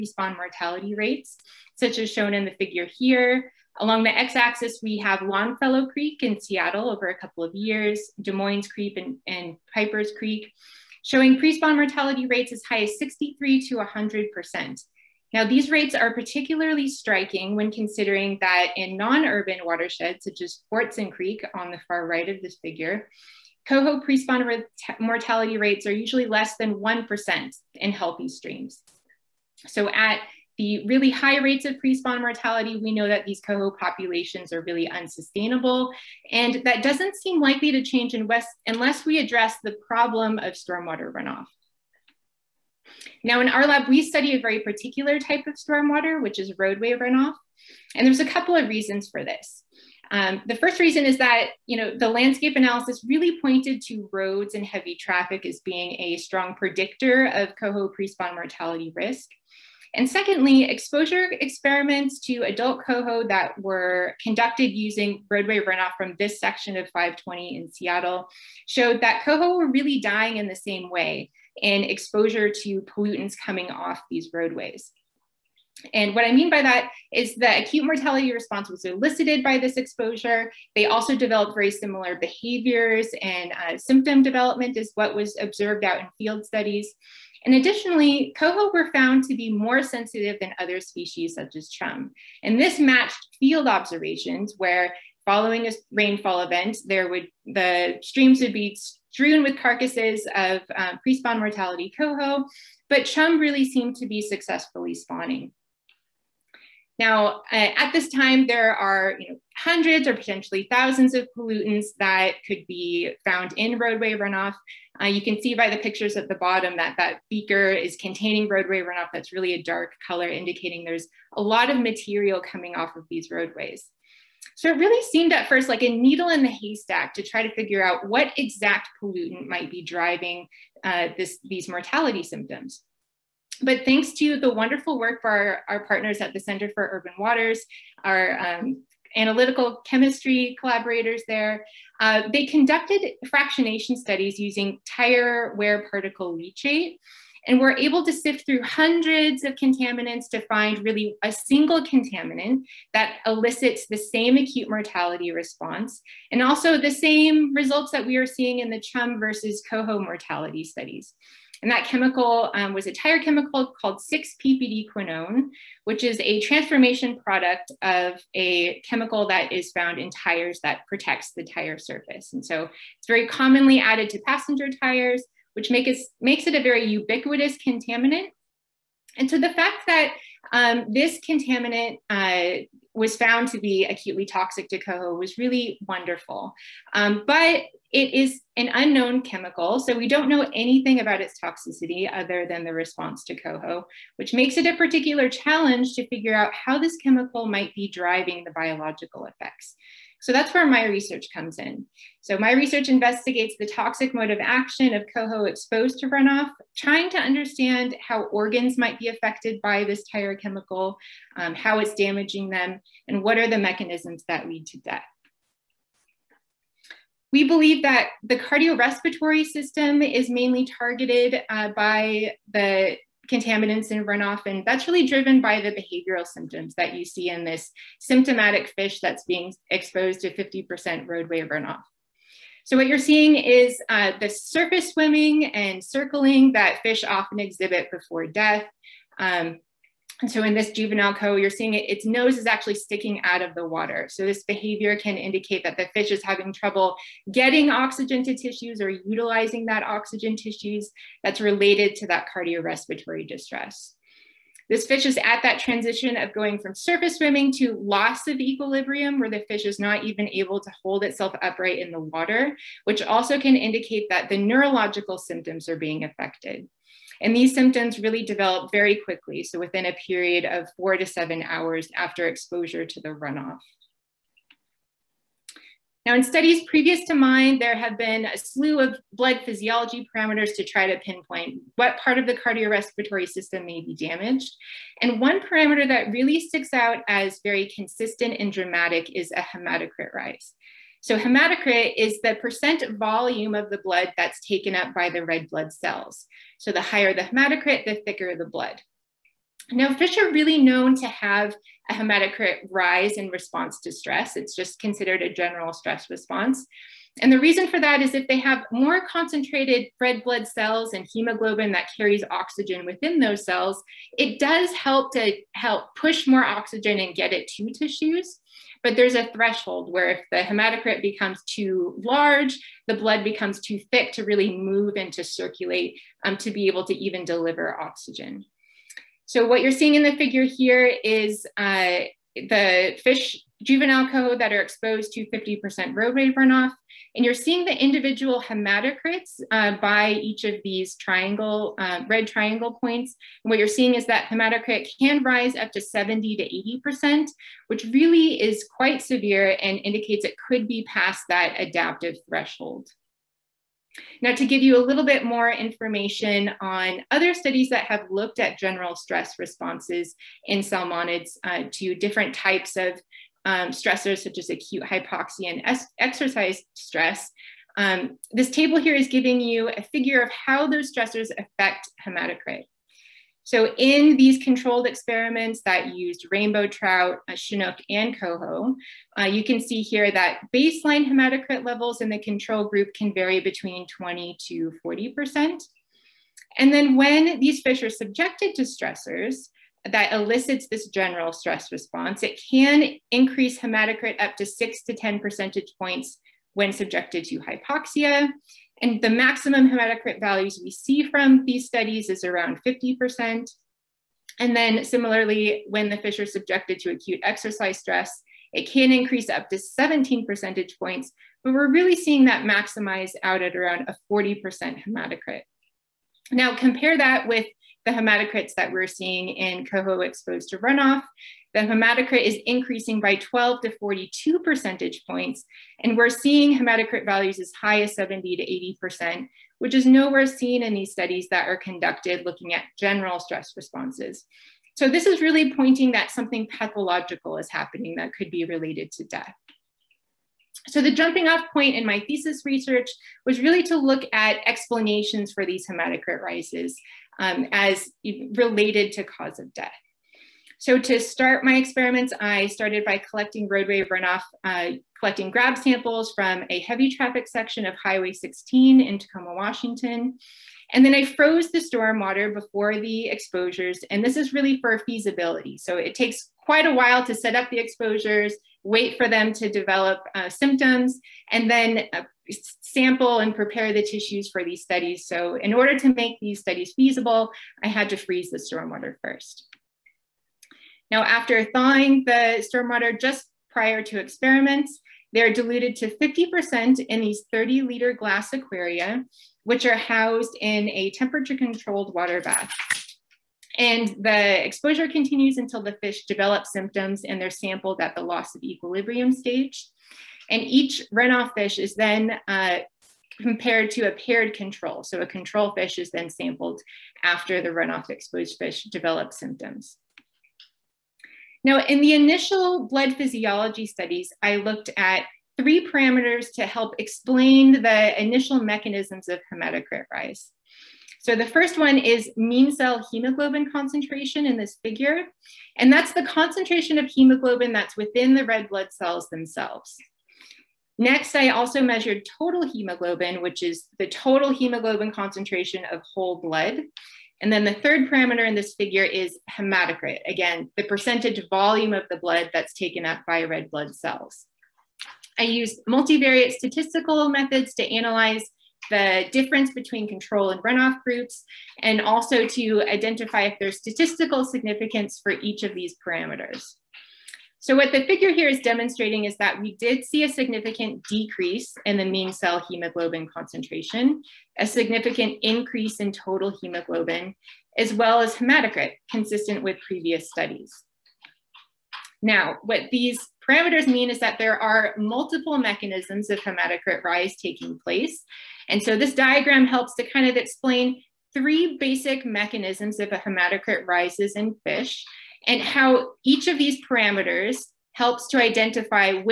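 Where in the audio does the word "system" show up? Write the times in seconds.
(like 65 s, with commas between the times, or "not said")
219 s, 283 s.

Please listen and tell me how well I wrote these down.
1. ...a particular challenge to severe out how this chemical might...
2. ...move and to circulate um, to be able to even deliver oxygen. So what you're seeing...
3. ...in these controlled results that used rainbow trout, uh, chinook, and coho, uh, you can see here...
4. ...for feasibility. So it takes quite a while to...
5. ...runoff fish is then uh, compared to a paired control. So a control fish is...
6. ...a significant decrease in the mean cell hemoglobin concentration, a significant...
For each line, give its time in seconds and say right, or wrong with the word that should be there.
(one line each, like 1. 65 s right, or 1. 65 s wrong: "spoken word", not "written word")
1. 194 s wrong: "figure", not "severe"
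2. 324 s right
3. 373 s wrong: "experiments", not "results"
4. 464 s right
5. 500 s right
6. 560 s right.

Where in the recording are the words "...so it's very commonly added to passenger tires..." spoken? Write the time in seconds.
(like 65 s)
172 s.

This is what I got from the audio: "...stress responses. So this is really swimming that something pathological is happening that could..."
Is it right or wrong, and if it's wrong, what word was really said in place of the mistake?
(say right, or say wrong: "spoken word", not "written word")
wrong: "pointing", not "swimming".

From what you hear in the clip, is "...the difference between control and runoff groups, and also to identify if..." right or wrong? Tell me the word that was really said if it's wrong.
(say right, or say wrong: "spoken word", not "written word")
right.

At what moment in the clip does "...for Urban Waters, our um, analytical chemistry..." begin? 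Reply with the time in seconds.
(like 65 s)
136 s.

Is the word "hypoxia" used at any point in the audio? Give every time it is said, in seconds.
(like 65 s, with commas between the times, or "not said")
364 s, 397 s.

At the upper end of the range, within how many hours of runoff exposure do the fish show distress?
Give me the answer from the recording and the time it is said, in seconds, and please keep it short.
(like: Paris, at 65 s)
7, at 271 s.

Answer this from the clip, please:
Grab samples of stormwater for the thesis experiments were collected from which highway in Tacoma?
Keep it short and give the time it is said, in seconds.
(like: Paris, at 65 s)
Highway 16, at 457 s.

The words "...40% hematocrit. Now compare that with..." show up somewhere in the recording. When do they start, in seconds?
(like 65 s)
414 s.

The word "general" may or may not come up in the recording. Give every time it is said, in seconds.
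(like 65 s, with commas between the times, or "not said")
305 s, 358 s, 390 s, 432 s.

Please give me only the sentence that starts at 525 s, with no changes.
And that's the concentration of hemoglobin that's within the red blood cells themselves.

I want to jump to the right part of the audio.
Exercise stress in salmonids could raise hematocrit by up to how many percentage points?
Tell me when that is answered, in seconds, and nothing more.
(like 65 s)
409 s.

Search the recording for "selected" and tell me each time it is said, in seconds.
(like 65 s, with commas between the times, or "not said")
not said.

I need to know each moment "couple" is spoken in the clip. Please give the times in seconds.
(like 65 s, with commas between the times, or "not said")
7 s, 48 s.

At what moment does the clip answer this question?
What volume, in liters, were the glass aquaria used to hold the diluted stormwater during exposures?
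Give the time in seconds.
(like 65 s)
487 s.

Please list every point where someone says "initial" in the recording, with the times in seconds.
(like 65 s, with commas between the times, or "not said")
511 s, 518 s.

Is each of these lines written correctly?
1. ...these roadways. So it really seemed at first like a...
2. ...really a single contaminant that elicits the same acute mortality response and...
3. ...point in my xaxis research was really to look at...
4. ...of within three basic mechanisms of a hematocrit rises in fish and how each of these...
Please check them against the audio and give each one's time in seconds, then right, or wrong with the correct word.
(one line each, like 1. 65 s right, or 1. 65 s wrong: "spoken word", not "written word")
1. 123 s right
2. 150 s right
3. 441 s wrong: "thesis", not "xaxis"
4. 580 s wrong: "explain", not "within".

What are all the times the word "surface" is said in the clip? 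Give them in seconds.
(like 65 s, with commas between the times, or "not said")
171 s, 234 s, 256 s.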